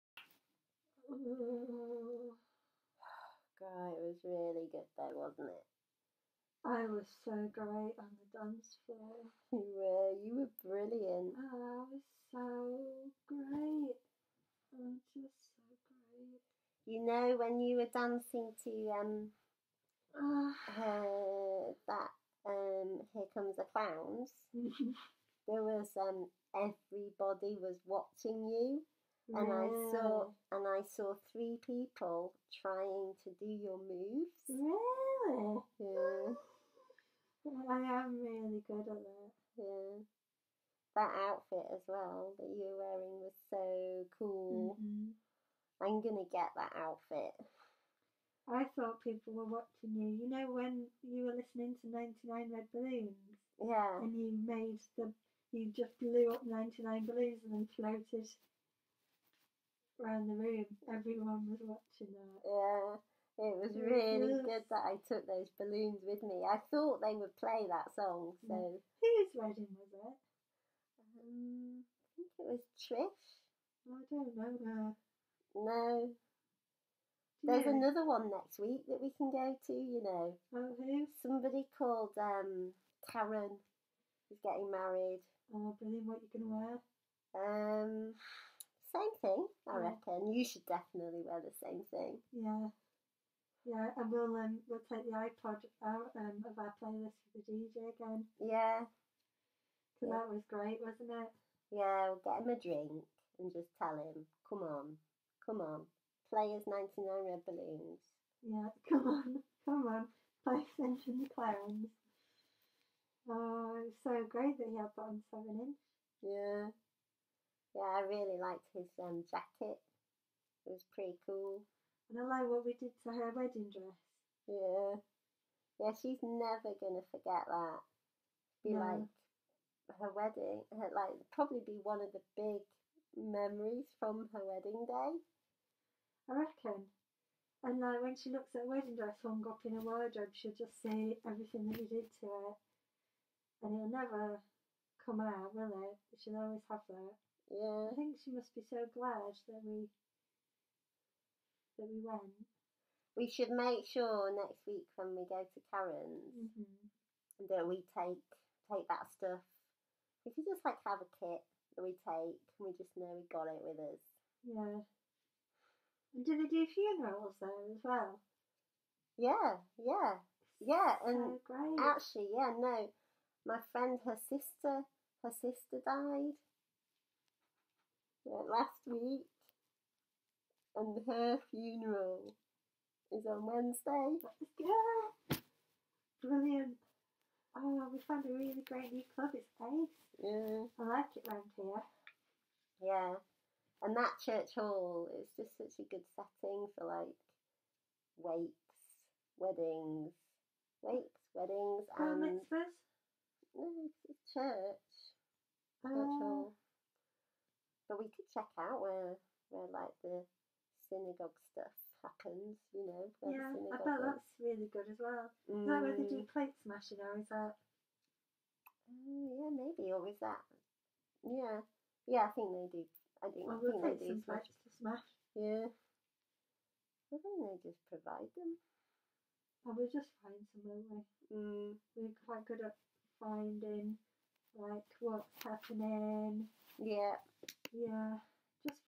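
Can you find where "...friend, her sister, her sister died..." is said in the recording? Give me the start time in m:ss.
2:53.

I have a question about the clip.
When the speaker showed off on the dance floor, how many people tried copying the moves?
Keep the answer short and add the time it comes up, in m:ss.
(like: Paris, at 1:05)
3, at 0:31.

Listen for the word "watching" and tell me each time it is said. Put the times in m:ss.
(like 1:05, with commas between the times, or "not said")
0:27, 0:49, 1:01.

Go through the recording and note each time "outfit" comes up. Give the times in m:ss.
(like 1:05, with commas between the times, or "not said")
0:41, 0:46.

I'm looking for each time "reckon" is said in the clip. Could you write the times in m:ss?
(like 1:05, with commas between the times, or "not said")
1:29, 2:16.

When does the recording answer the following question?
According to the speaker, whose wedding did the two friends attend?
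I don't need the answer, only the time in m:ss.
1:12.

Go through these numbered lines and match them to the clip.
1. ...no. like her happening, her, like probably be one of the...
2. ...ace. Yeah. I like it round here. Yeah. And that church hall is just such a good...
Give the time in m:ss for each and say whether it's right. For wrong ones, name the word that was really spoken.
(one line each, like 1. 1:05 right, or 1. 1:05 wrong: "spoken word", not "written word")
1. 2:08 wrong: "wedding", not "happening"
2. 3:09 right.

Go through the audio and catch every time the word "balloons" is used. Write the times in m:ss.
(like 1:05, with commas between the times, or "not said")
0:52, 0:57, 1:05, 1:47.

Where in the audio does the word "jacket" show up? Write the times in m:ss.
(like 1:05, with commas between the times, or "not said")
1:59.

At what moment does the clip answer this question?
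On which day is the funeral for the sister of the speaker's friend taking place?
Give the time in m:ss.
3:03.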